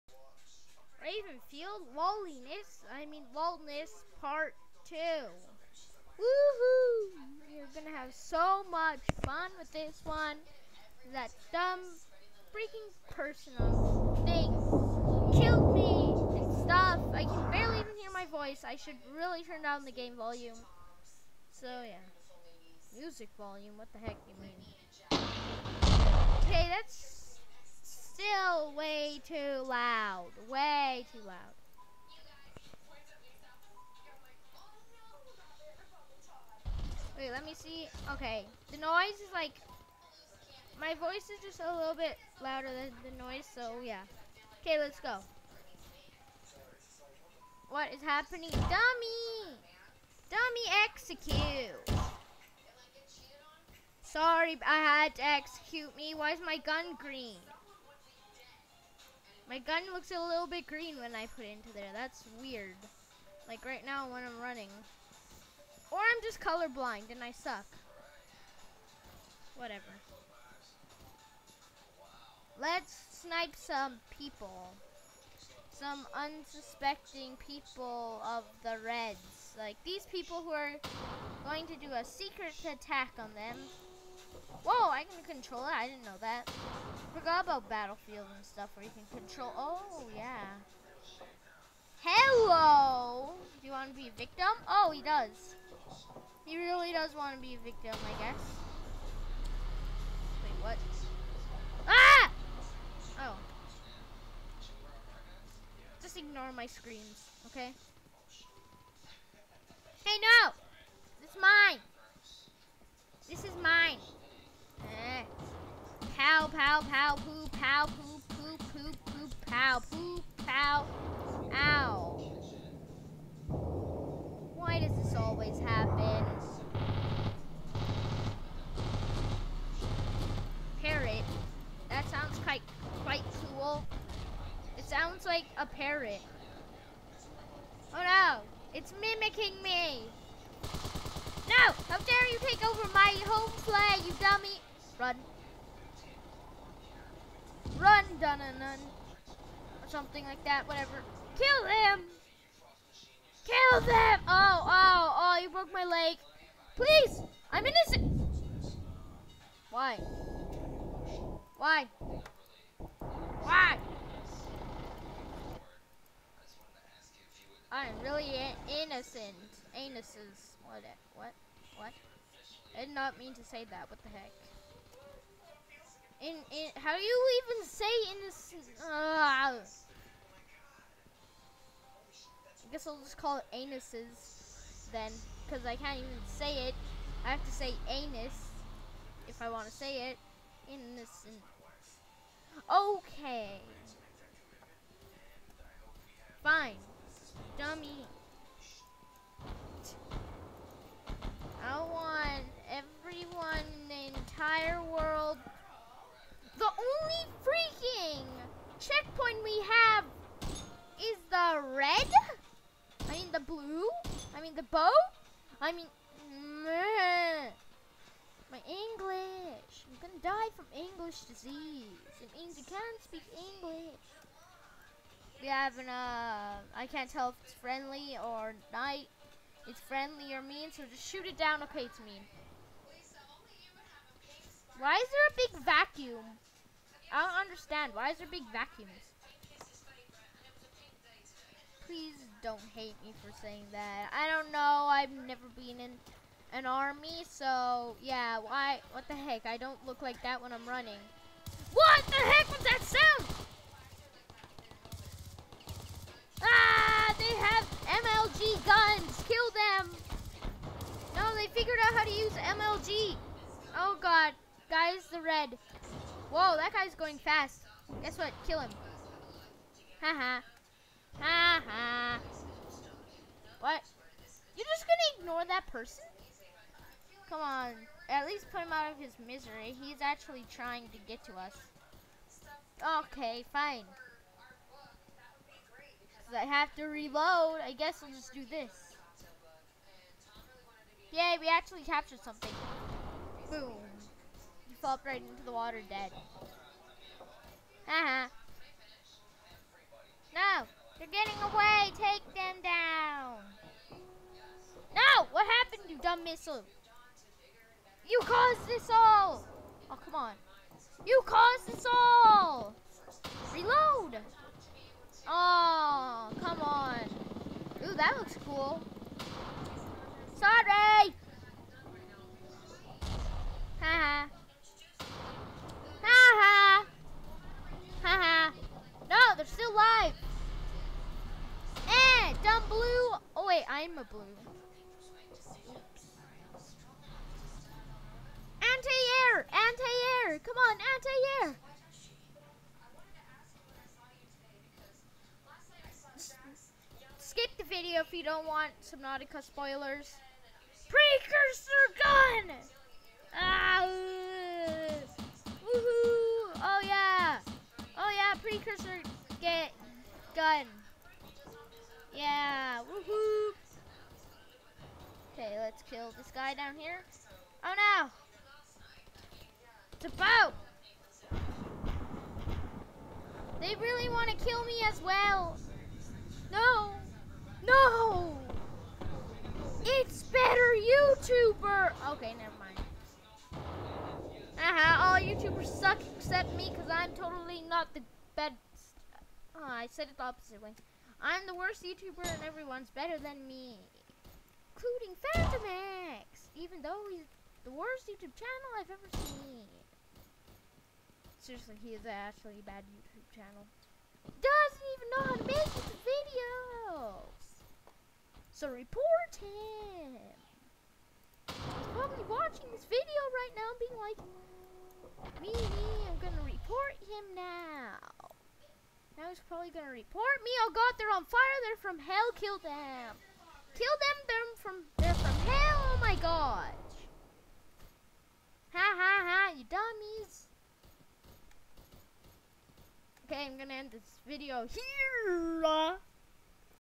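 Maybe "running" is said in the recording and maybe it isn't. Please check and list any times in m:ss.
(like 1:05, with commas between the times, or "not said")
1:04, 4:10.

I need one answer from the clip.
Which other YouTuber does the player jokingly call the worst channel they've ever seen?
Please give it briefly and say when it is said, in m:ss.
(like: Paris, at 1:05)
Phantom, at 6:35.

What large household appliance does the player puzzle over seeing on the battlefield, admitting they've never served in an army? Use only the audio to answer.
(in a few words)
Vacuum.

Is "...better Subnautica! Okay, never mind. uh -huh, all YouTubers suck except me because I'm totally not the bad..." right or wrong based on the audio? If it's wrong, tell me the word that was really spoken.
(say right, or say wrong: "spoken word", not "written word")
wrong: "YouTuber", not "Subnautica".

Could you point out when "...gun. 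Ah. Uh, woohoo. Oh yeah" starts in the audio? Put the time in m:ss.
5:52.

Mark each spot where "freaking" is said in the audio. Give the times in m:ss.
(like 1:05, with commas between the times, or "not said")
0:12, 3:27.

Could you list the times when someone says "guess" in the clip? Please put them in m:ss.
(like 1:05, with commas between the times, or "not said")
1:38, 3:02, 4:28, 4:47.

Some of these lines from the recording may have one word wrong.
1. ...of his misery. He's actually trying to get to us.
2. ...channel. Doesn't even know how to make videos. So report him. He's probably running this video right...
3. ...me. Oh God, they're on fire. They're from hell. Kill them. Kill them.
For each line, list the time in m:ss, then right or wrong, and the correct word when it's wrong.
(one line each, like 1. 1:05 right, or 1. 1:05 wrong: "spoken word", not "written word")
1. 4:38 right
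2. 6:43 wrong: "watching", not "running"
3. 7:00 right.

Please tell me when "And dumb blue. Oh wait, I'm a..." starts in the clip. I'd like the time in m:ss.
5:31.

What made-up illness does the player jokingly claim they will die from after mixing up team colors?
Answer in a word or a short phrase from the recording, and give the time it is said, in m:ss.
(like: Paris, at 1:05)
English disease, at 3:40.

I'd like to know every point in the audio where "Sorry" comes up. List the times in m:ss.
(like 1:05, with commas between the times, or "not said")
0:54, 5:20.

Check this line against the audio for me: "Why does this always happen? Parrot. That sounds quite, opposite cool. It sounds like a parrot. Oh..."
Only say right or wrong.
wrong.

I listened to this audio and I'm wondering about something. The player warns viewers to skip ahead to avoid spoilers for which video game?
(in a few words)
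Subnautica.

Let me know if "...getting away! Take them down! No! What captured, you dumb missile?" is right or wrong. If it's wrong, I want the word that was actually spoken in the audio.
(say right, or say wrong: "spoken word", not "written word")
wrong: "happened", not "captured".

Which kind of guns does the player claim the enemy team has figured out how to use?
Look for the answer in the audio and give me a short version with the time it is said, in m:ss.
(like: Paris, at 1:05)
MLG guns, at 4:18.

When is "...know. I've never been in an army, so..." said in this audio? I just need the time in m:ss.
4:04.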